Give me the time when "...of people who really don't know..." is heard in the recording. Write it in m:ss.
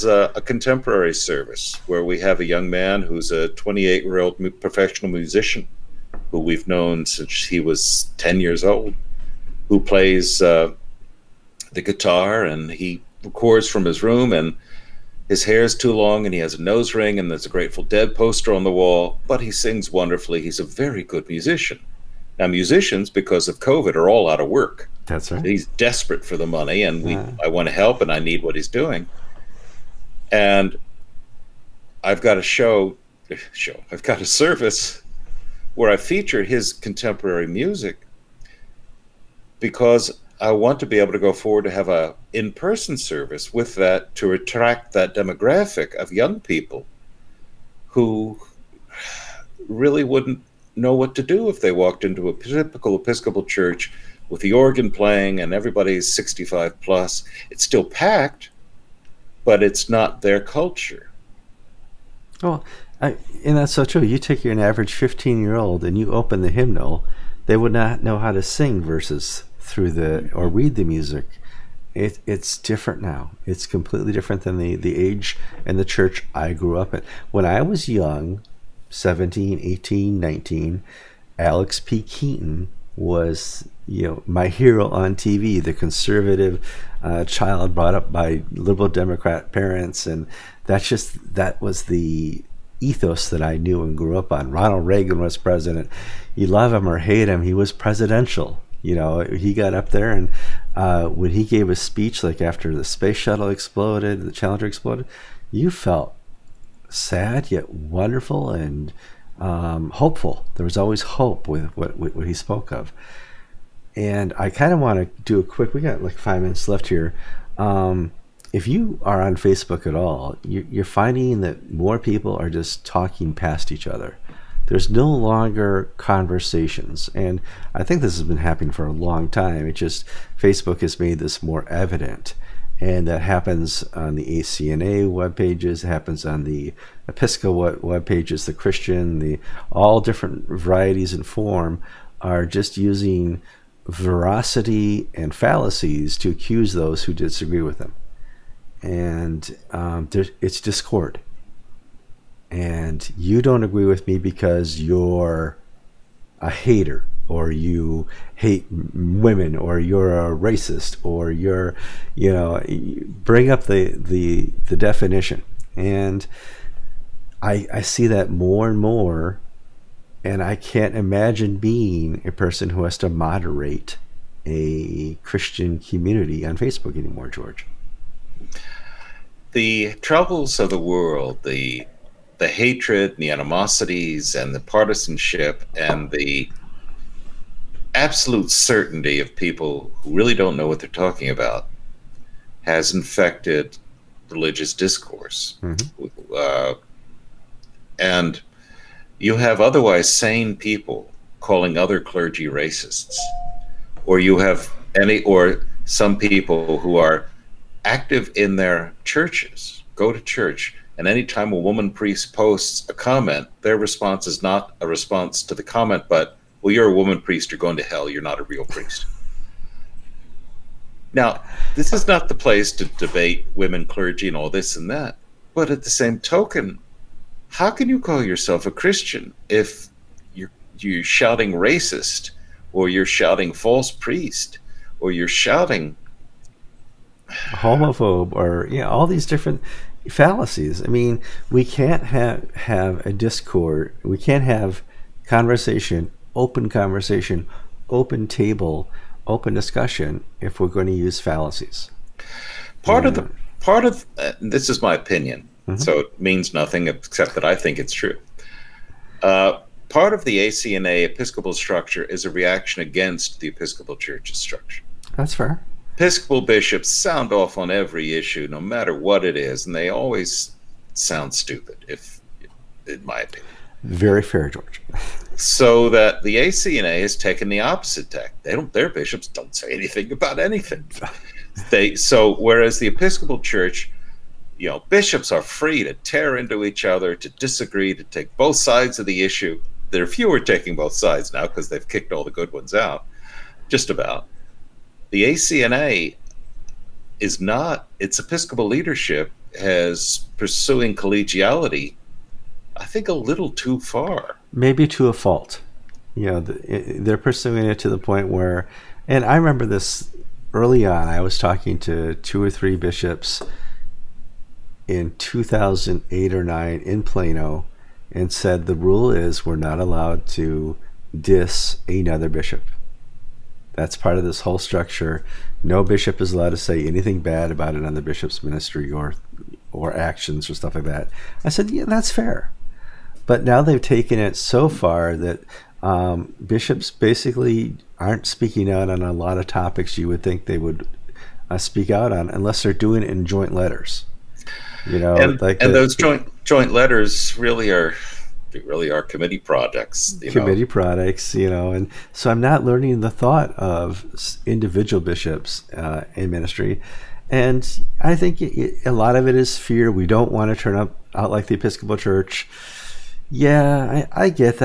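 3:09.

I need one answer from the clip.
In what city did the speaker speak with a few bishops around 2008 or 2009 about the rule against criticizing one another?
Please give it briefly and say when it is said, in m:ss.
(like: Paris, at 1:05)
Plano, at 5:17.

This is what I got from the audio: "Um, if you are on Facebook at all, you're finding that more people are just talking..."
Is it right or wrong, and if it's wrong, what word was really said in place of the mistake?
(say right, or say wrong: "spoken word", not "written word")
right.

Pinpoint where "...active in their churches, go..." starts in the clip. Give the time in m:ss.
3:27.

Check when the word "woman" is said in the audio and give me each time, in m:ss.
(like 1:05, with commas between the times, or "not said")
3:31, 3:36.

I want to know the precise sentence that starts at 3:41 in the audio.
Now, this is not the place to debate women clergy and all this and that.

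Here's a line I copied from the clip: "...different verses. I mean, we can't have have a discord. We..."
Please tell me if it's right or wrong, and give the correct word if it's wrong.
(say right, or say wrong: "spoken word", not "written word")
wrong: "fallacies", not "verses".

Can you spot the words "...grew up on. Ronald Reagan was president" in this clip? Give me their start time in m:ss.
1:33.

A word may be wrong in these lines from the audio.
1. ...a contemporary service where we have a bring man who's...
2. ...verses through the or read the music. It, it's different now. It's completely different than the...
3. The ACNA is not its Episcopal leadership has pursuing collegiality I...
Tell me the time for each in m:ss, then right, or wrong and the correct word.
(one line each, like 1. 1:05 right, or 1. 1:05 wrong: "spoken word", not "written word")
1. 0:00 wrong: "young", not "bring"
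2. 1:08 right
3. 4:55 right.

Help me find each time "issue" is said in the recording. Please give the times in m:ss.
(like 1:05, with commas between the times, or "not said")
4:28, 4:49.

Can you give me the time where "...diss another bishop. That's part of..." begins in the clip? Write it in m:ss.
5:21.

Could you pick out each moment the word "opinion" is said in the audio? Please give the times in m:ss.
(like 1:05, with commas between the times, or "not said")
4:14, 4:33.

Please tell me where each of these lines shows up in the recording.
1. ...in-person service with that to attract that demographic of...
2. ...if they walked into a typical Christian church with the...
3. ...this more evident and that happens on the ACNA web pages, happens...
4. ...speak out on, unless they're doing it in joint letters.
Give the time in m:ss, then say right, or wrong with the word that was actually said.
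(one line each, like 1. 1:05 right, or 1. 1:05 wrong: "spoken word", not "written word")
1. 0:42 right
2. 0:51 wrong: "Episcopal", not "Christian"
3. 2:11 right
4. 5:41 right.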